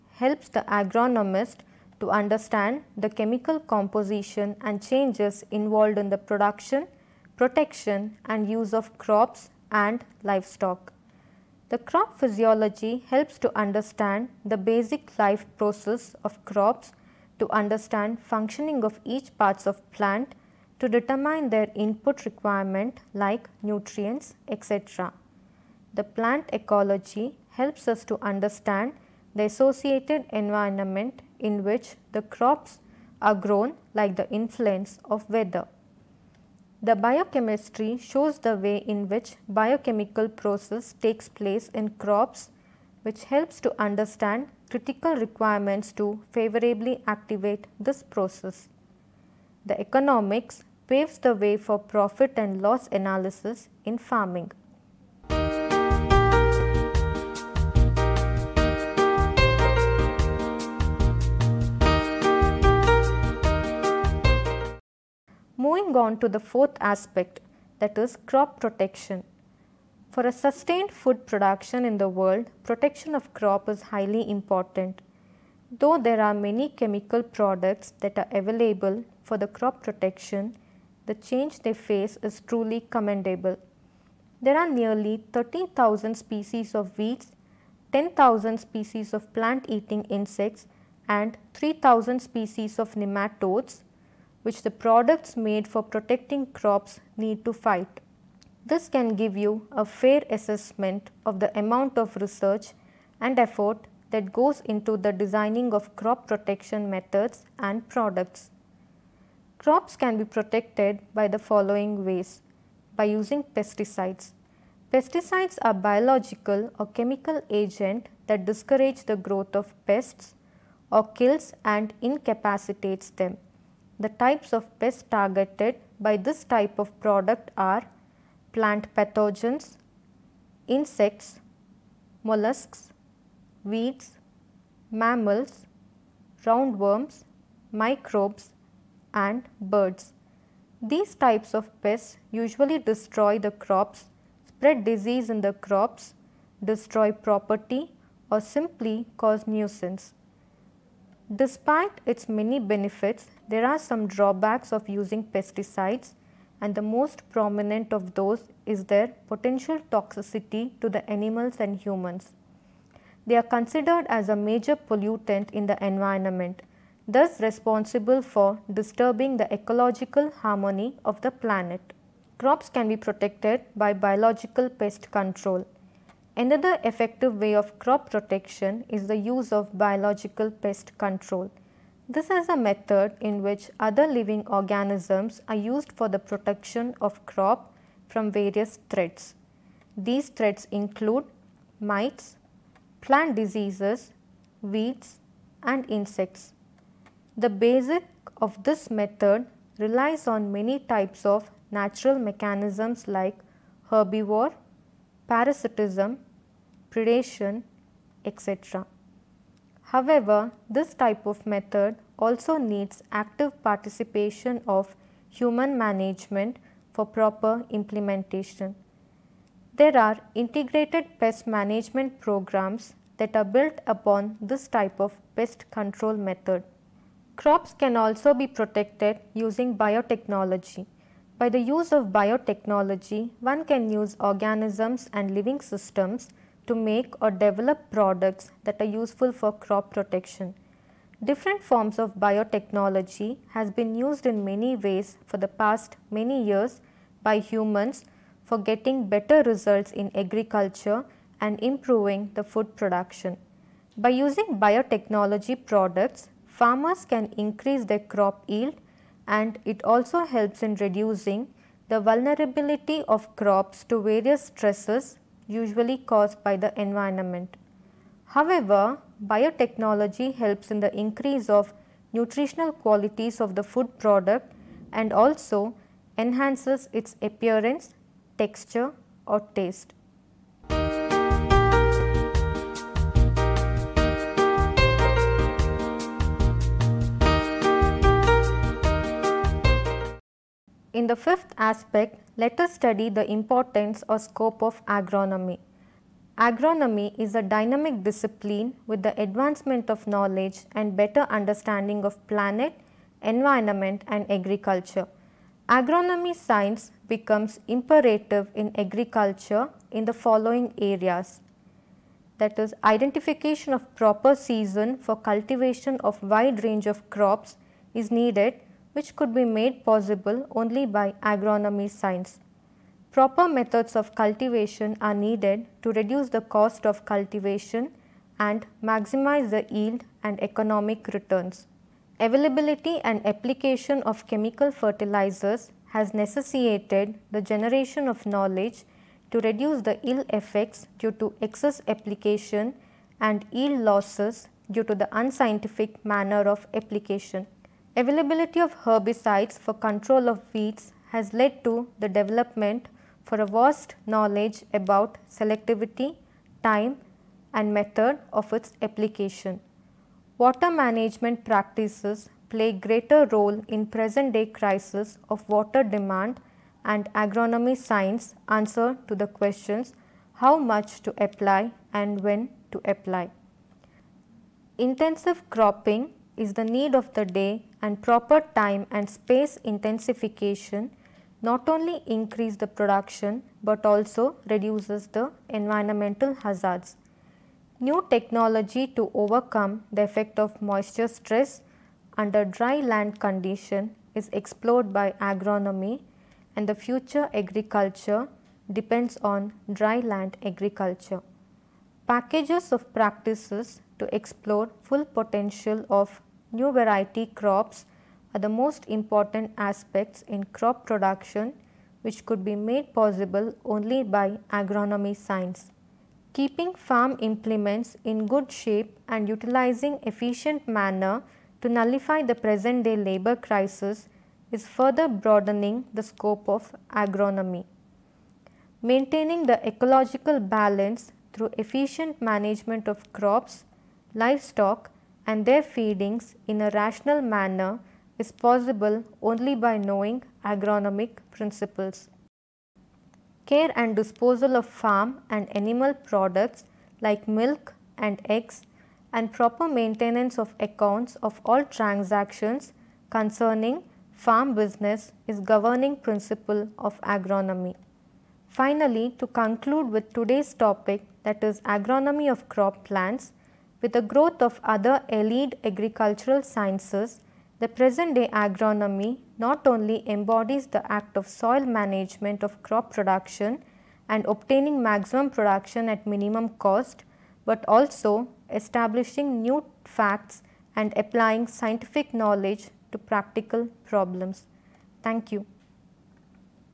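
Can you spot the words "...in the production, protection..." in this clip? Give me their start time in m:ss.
0:05.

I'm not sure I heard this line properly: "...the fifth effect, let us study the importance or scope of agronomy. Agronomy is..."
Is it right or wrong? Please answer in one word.
wrong.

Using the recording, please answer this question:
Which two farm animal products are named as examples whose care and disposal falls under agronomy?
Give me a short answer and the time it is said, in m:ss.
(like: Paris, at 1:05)
Milk and eggs, at 7:27.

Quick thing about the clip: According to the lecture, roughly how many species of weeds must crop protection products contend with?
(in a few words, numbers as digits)
13,000.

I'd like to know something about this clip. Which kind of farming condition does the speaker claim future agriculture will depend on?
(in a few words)
Dry land agriculture.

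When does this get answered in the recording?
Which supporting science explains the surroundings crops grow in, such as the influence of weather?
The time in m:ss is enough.
0:26.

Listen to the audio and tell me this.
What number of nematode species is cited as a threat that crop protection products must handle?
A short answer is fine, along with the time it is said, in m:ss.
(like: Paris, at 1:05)
3,000, at 1:31.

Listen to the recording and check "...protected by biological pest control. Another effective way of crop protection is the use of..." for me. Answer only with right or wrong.
right.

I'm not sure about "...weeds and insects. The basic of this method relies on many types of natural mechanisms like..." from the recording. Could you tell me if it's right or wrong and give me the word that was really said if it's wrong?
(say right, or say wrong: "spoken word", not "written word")
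right.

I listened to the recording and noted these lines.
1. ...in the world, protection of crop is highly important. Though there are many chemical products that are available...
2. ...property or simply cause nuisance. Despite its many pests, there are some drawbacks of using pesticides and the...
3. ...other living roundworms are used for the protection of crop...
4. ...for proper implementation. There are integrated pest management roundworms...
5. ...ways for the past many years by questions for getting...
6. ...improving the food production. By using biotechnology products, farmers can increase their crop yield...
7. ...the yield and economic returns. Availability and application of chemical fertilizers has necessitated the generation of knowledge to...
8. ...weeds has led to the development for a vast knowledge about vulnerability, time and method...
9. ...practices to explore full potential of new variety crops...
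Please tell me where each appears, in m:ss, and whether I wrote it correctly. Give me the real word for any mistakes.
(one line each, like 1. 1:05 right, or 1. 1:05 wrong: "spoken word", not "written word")
1. 1:11 right
2. 2:27 wrong: "benefits", not "pests"
3. 3:03 wrong: "organisms", not "roundworms"
4. 3:36 wrong: "programs", not "roundworms"
5. 4:04 wrong: "humans", not "questions"
6. 4:11 right
7. 5:29 right
8. 5:50 wrong: "selectivity", not "vulnerability"
9. 6:42 right.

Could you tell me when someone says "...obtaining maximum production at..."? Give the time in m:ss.
7:54.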